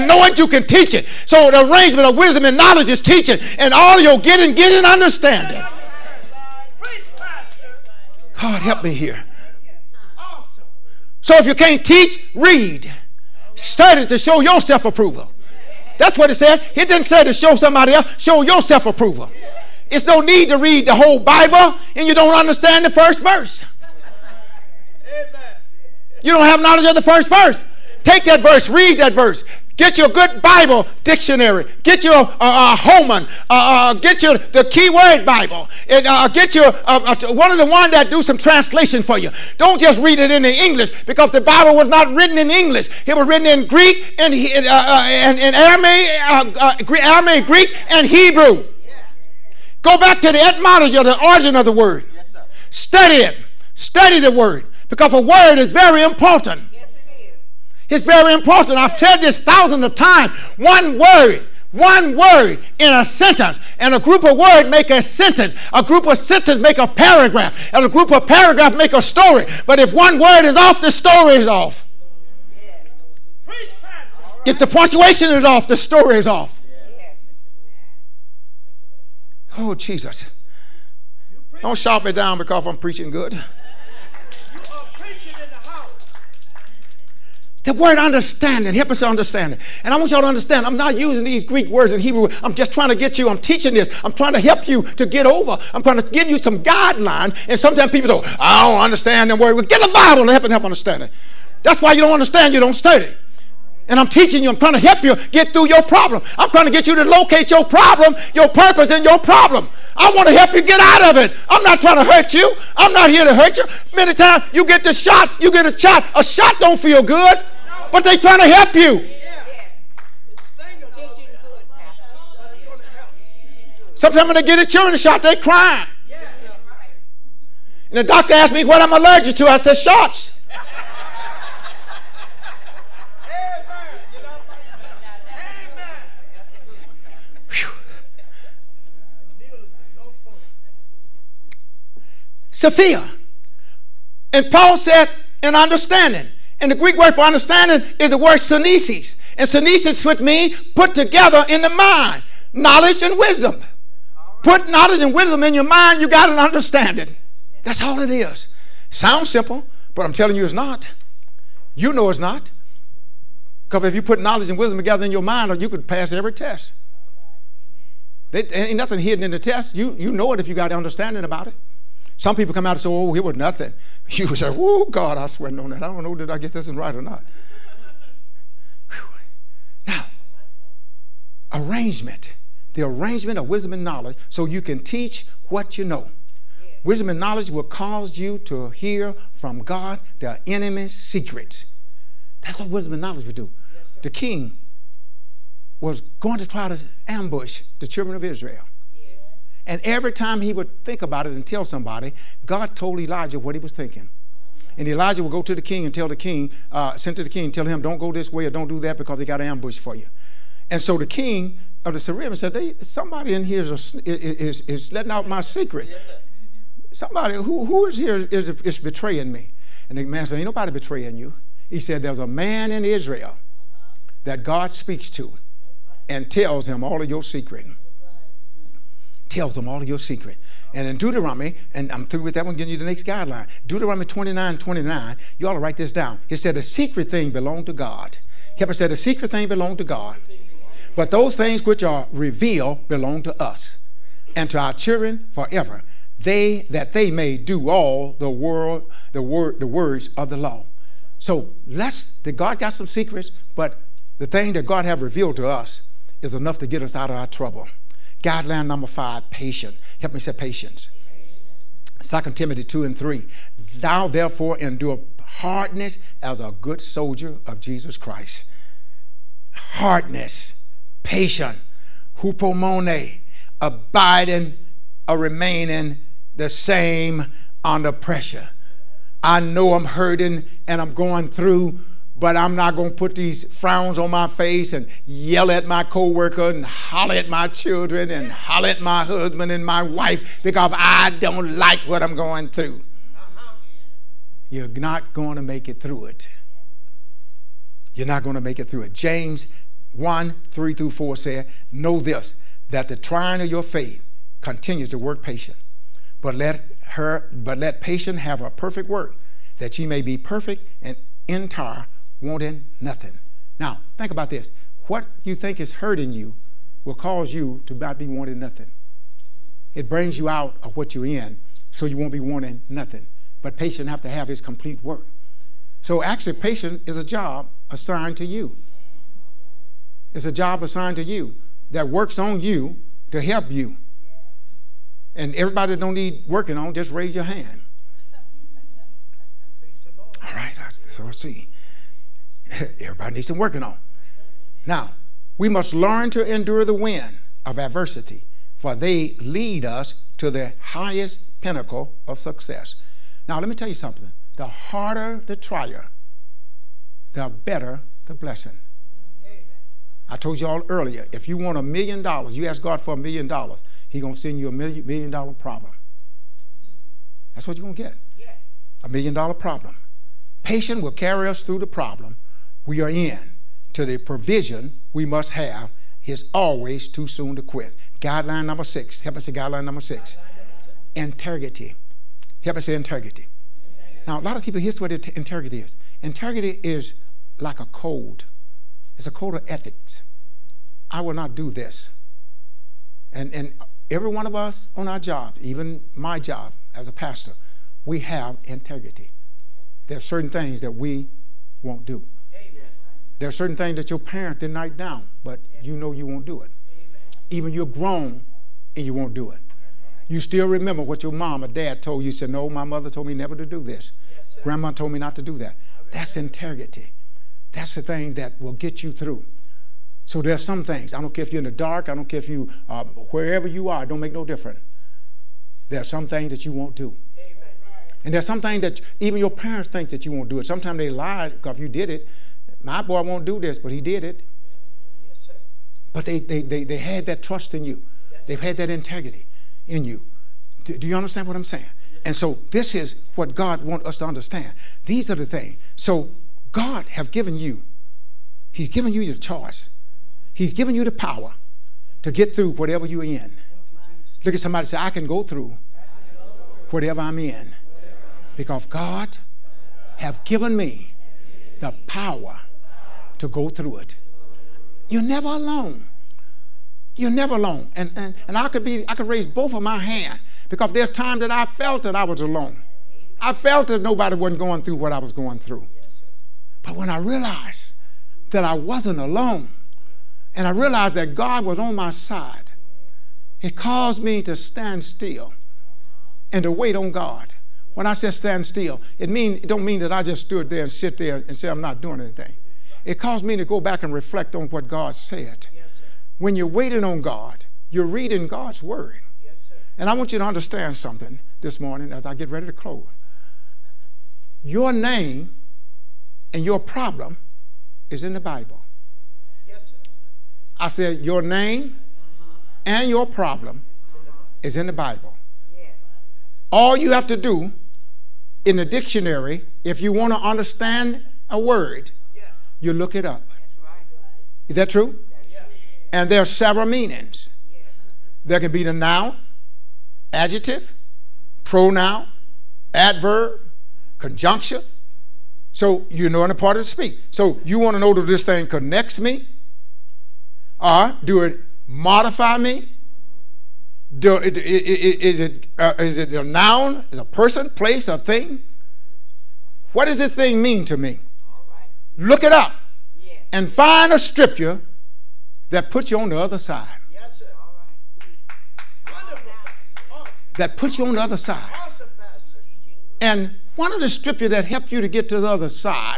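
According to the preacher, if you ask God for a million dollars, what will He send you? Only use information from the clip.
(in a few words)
a million dollar problem.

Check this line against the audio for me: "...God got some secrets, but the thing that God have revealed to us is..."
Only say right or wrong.
right.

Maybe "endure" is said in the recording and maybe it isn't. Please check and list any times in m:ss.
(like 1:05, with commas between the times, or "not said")
4:24, 5:46.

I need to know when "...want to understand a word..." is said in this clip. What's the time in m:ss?
8:39.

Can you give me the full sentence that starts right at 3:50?
And in Deuteronomy, and I'm through with that one, giving you the next guideline.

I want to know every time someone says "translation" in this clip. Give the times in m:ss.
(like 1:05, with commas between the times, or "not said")
0:38.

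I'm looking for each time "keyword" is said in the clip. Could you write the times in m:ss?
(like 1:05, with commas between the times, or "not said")
0:34.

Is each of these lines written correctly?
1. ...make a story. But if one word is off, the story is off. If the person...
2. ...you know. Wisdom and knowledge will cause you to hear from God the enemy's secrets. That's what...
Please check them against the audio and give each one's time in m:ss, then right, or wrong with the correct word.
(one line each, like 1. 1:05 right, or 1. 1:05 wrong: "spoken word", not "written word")
1. 1:08 wrong: "punctuation", not "person"
2. 3:05 right.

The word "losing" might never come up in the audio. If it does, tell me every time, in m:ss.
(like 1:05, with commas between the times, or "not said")
not said.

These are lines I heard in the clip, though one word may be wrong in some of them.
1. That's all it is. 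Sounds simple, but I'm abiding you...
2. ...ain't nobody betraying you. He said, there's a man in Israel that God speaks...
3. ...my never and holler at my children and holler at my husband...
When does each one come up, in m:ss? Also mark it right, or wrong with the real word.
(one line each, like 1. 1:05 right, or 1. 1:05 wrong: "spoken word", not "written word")
1. 2:37 wrong: "telling", not "abiding"
2. 3:40 right
3. 4:45 wrong: "coworker", not "never".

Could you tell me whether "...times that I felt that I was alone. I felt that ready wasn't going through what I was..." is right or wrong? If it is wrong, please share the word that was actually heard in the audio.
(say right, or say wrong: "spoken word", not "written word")
wrong: "nobody", not "ready".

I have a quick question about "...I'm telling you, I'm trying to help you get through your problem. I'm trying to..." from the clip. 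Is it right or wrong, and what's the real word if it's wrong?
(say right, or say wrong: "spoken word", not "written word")
wrong: "teaching", not "telling".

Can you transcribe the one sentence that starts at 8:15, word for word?
Yes, when you're waiting on God, you're reading God's word.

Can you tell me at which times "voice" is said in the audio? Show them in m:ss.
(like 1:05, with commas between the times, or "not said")
not said.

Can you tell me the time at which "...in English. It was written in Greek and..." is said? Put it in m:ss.
0:42.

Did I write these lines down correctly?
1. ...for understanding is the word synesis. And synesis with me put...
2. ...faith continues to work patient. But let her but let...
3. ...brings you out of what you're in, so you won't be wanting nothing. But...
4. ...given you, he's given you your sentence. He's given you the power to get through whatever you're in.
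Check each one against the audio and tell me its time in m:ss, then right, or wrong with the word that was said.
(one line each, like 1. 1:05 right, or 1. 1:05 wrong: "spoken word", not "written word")
1. 2:27 right
2. 5:03 right
3. 5:19 right
4. 7:27 wrong: "choice", not "sentence".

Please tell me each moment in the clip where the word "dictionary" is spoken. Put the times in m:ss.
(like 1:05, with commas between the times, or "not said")
0:31, 8:38.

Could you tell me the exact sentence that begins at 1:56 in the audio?
A shot don't feel good but they're trying to help you.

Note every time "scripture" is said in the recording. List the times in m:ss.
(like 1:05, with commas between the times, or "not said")
9:13, 9:23.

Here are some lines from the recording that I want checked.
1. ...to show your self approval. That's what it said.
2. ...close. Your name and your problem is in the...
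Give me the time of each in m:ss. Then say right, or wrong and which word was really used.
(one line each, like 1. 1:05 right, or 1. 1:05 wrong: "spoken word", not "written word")
1. 0:14 right
2. 8:22 right.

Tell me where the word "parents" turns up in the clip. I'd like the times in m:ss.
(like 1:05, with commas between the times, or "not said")
6:43, 7:09.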